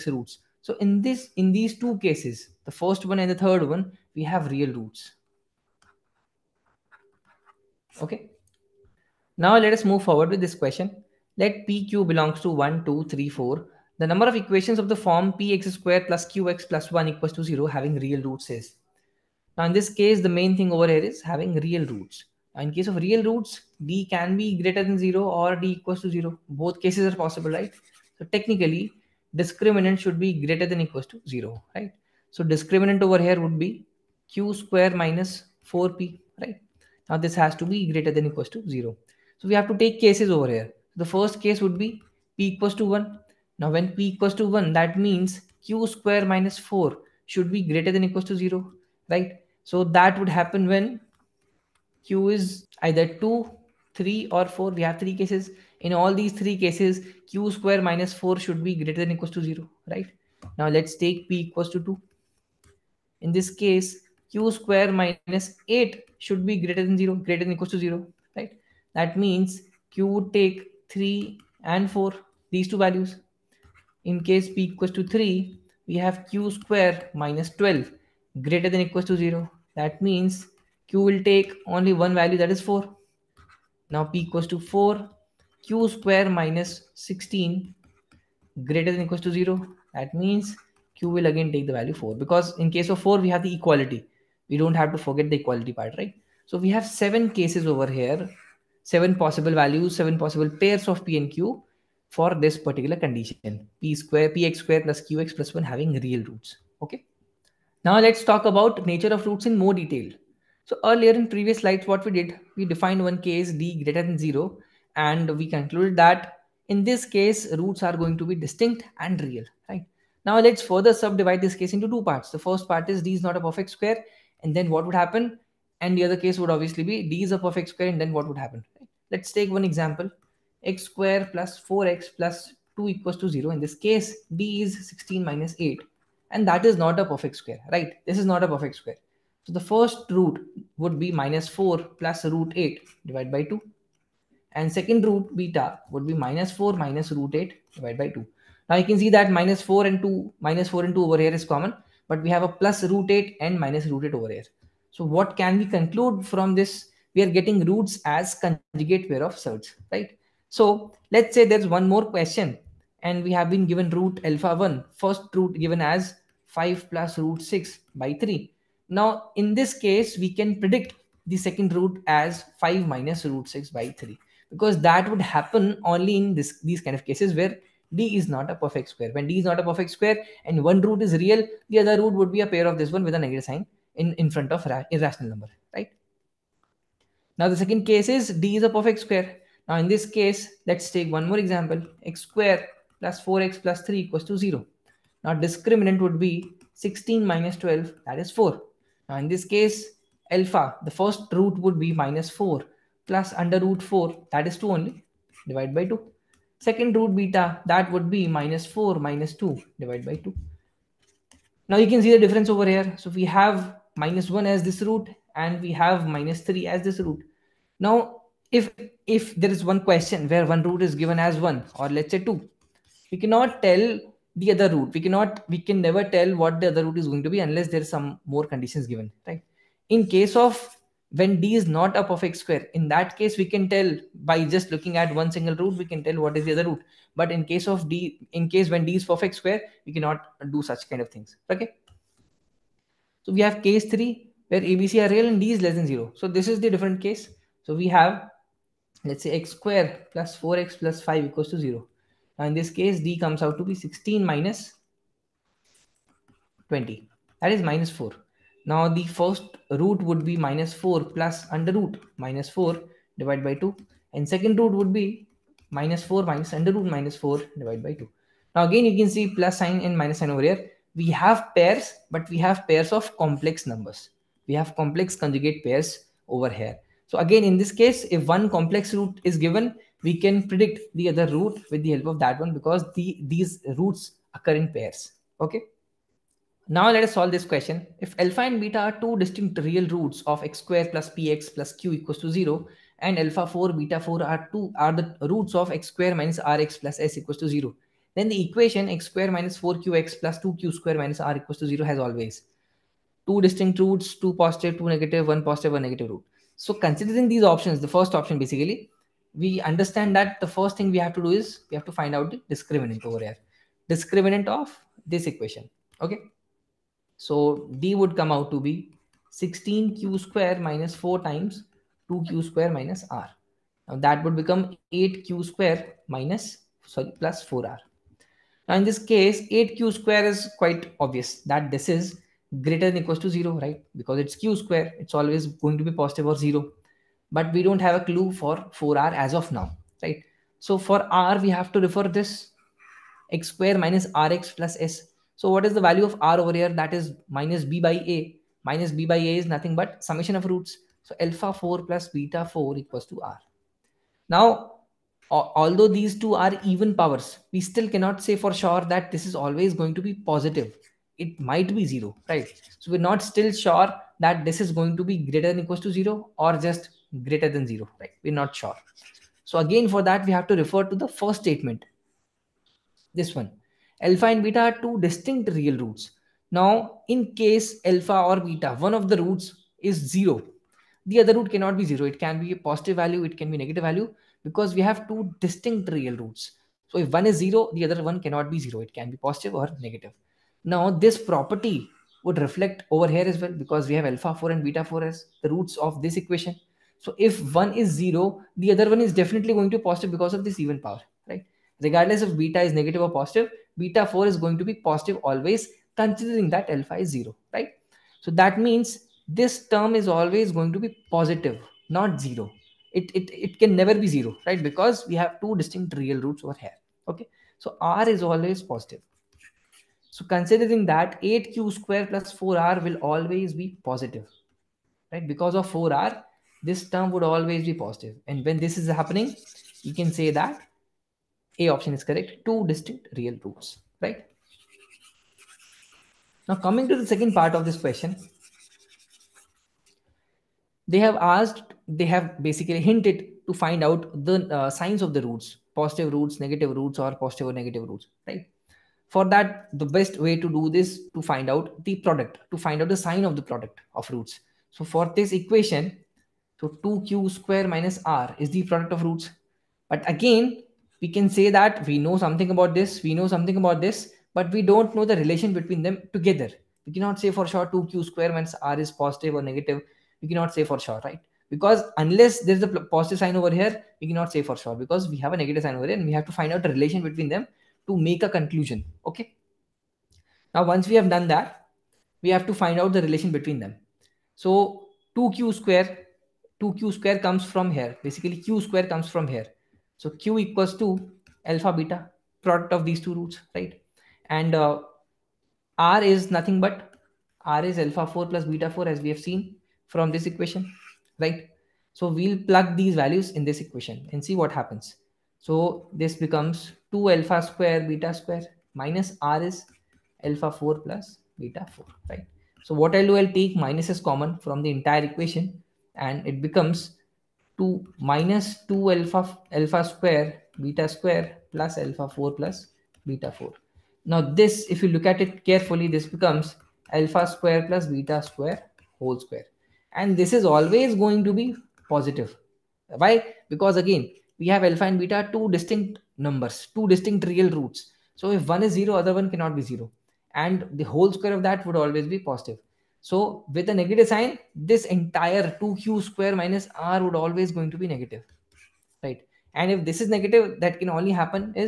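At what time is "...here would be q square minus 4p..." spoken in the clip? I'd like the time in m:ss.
0:33.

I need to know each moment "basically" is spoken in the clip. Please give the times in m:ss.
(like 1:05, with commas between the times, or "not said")
5:08, 7:22, 8:08.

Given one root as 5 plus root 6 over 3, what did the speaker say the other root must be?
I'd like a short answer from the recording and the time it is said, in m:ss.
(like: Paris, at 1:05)
5 minus root 6 by 3, at 2:52.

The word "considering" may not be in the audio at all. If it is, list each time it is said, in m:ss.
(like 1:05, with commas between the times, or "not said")
5:06, 6:45, 7:00.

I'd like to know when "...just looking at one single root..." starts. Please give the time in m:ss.
3:54.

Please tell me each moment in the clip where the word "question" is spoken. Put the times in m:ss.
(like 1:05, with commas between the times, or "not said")
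0:10, 2:42, 3:39, 4:47, 7:17.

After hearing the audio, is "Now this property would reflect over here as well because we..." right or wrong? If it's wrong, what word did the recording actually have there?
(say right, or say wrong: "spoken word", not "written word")
right.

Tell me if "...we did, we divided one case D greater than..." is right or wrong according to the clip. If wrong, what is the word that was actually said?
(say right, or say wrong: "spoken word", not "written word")
wrong: "defined", not "divided".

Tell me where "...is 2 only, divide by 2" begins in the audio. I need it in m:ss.
3:24.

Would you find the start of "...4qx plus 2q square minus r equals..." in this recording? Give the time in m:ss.
4:59.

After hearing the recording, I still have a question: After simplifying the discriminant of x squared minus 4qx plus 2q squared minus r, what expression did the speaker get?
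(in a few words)
8q² + 4r.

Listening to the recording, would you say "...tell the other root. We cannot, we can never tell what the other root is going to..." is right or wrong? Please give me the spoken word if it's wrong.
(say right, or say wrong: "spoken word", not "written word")
right.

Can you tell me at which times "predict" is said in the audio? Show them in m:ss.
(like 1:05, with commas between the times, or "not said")
2:50, 4:40.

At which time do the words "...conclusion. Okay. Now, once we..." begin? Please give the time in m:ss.
7:58.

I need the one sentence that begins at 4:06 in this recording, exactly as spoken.
So this is the different case.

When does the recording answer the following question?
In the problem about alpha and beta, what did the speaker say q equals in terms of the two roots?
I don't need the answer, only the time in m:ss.
8:11.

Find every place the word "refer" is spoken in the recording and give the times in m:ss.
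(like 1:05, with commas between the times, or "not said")
5:41, 6:10.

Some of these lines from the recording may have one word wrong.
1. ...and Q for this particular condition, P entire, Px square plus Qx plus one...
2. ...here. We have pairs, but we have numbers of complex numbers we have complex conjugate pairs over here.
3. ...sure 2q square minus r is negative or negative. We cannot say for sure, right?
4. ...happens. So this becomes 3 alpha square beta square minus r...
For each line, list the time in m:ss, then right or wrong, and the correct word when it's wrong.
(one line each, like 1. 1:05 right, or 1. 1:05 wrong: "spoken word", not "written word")
1. 1:41 wrong: "square", not "entire"
2. 4:30 wrong: "pairs", not "numbers"
3. 7:47 wrong: "positive", not "negative"
4. 8:24 wrong: "2", not "3".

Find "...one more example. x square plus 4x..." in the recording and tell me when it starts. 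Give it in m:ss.
3:11.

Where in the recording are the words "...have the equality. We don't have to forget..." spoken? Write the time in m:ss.
1:33.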